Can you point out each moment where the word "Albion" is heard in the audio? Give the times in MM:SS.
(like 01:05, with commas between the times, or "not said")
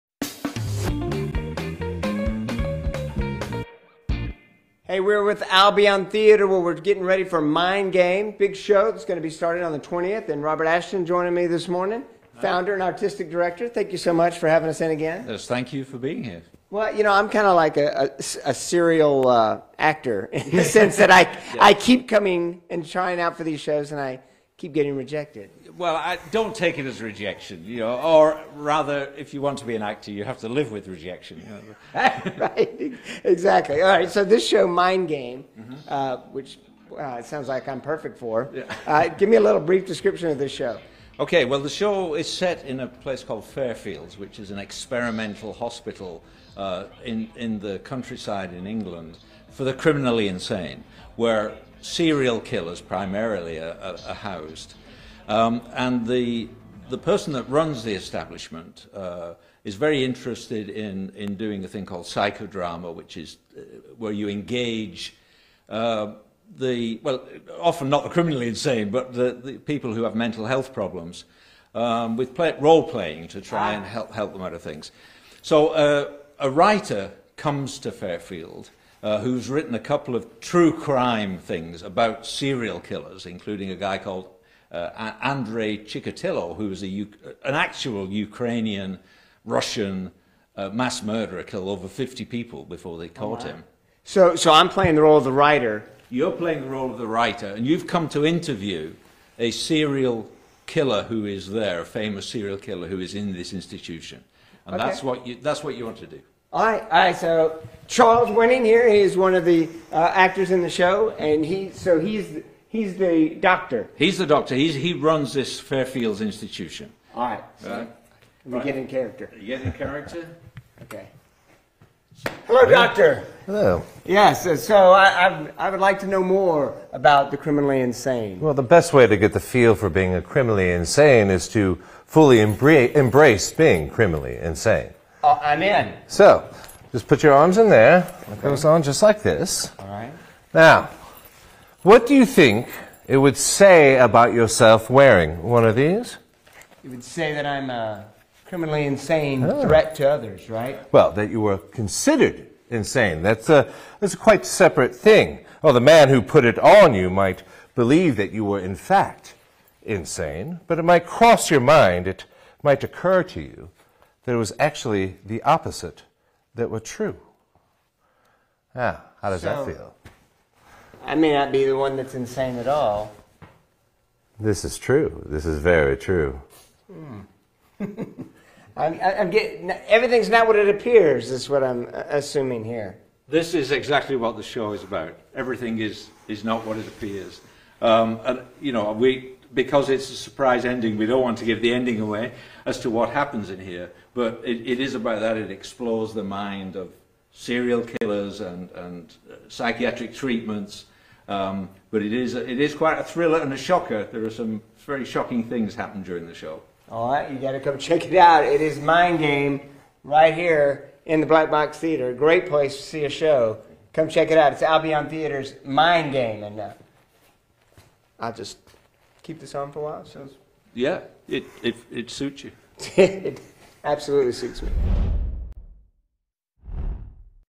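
00:05, 03:34.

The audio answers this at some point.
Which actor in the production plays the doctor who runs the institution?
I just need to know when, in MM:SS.
01:47.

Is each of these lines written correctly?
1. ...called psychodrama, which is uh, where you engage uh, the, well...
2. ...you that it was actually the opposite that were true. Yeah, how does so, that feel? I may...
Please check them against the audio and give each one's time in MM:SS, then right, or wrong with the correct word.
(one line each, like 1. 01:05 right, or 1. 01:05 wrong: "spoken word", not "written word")
1. 01:01 right
2. 02:43 right.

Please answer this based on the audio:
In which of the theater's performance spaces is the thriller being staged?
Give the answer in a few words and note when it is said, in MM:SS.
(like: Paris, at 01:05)
Black Box Theater, at 03:31.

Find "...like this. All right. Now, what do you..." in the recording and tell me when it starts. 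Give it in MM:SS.
02:19.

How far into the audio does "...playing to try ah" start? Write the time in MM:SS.
01:12.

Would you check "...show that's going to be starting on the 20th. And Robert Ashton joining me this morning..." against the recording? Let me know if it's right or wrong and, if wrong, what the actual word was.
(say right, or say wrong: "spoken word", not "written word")
right.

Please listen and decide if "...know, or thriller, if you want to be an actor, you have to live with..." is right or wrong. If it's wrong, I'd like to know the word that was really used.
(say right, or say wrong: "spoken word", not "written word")
wrong: "rather", not "thriller".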